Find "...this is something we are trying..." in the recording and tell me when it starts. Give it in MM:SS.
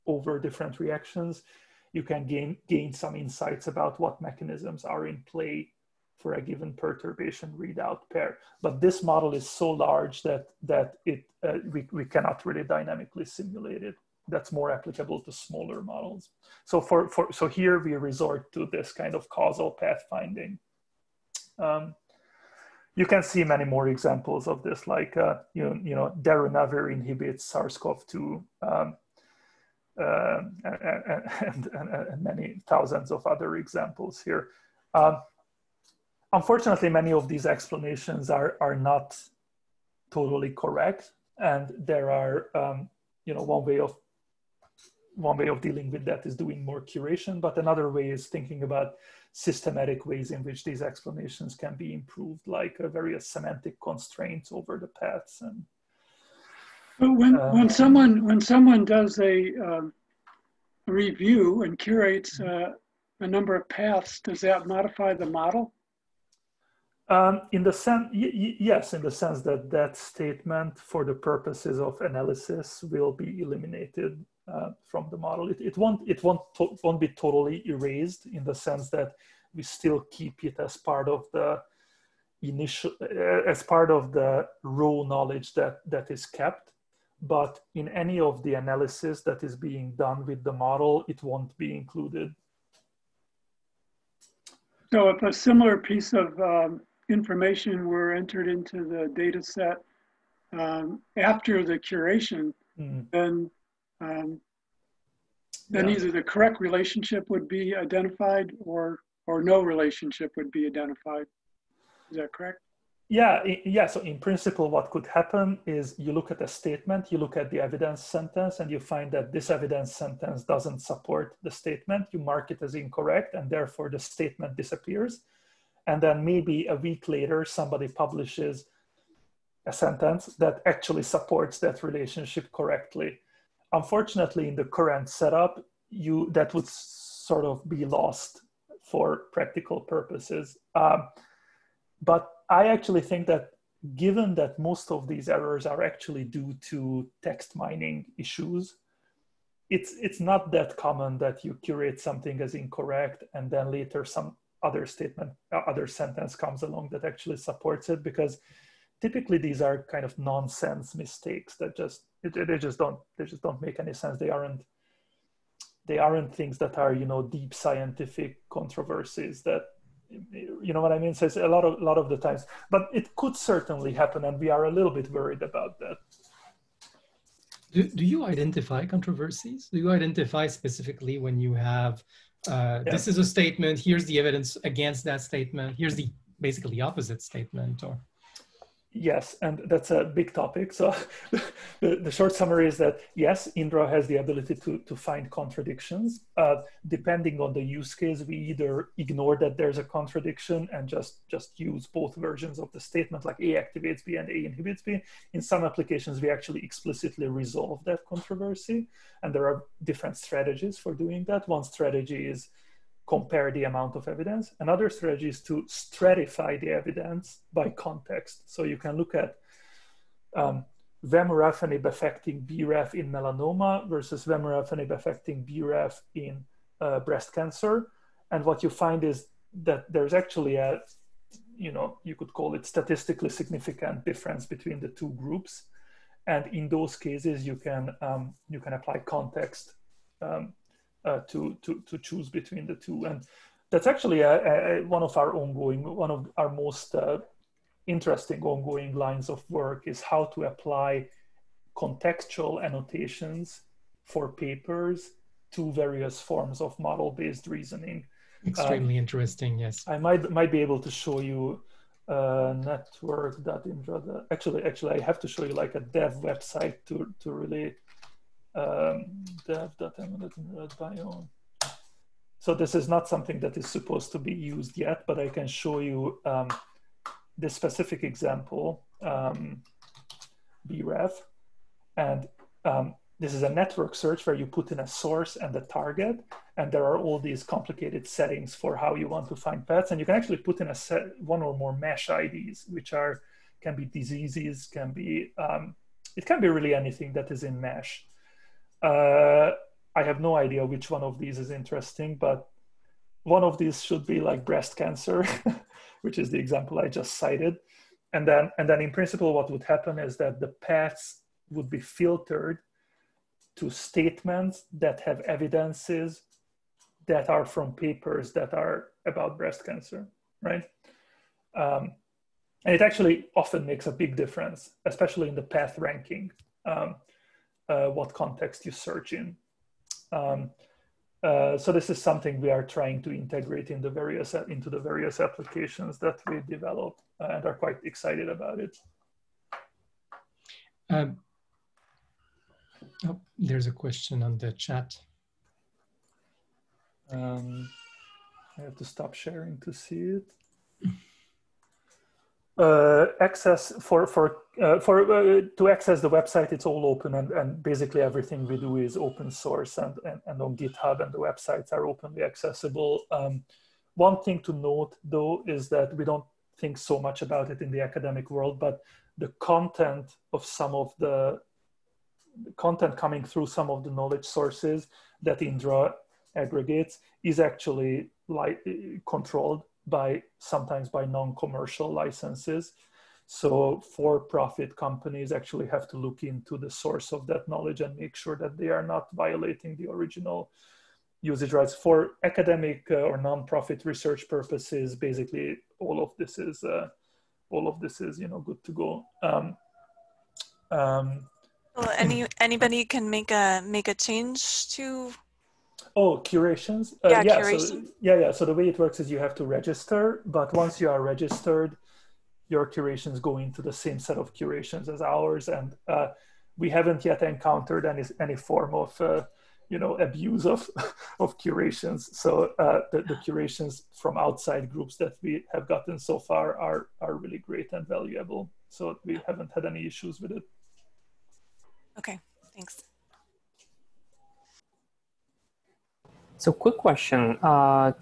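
05:31.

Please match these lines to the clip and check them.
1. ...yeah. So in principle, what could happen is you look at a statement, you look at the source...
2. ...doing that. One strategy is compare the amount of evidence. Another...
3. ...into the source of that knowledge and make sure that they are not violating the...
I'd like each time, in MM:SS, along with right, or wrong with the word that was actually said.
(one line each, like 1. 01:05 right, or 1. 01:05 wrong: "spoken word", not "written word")
1. 01:53 wrong: "evidence", not "source"
2. 03:30 right
3. 06:26 right.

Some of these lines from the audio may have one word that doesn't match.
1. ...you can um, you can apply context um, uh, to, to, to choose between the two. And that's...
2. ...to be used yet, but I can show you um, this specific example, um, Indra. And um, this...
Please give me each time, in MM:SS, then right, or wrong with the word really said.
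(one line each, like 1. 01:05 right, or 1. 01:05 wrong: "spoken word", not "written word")
1. 03:57 right
2. 04:34 wrong: "BRAF", not "Indra".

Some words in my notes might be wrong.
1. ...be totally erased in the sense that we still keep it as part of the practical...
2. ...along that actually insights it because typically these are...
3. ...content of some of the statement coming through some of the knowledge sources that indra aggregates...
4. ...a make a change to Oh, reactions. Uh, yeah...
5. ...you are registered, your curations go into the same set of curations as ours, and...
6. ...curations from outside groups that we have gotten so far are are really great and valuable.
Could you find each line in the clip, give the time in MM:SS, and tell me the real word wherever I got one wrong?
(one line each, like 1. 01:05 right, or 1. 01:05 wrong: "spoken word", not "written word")
1. 01:17 wrong: "initial", not "practical"
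2. 02:36 wrong: "supports", not "insights"
3. 06:09 wrong: "content", not "statement"
4. 06:43 wrong: "curations", not "reactions"
5. 06:50 right
6. 07:03 right.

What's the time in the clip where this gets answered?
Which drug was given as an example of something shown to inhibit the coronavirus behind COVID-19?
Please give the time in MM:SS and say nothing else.
00:26.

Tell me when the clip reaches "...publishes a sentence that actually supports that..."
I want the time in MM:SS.
02:07.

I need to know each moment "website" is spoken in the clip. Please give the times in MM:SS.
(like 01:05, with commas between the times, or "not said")
04:26, 05:56, 06:01.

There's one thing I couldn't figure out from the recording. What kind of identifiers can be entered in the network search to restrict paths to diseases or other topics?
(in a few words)
MeSH IDs.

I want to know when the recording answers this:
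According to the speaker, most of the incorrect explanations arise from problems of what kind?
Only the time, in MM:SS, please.
02:27.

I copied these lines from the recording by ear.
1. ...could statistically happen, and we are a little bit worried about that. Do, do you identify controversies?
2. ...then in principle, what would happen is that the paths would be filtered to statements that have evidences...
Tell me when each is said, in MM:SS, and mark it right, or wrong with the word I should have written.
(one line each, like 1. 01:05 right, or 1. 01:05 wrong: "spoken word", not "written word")
1. 02:53 wrong: "certainly", not "statistically"
2. 05:08 right.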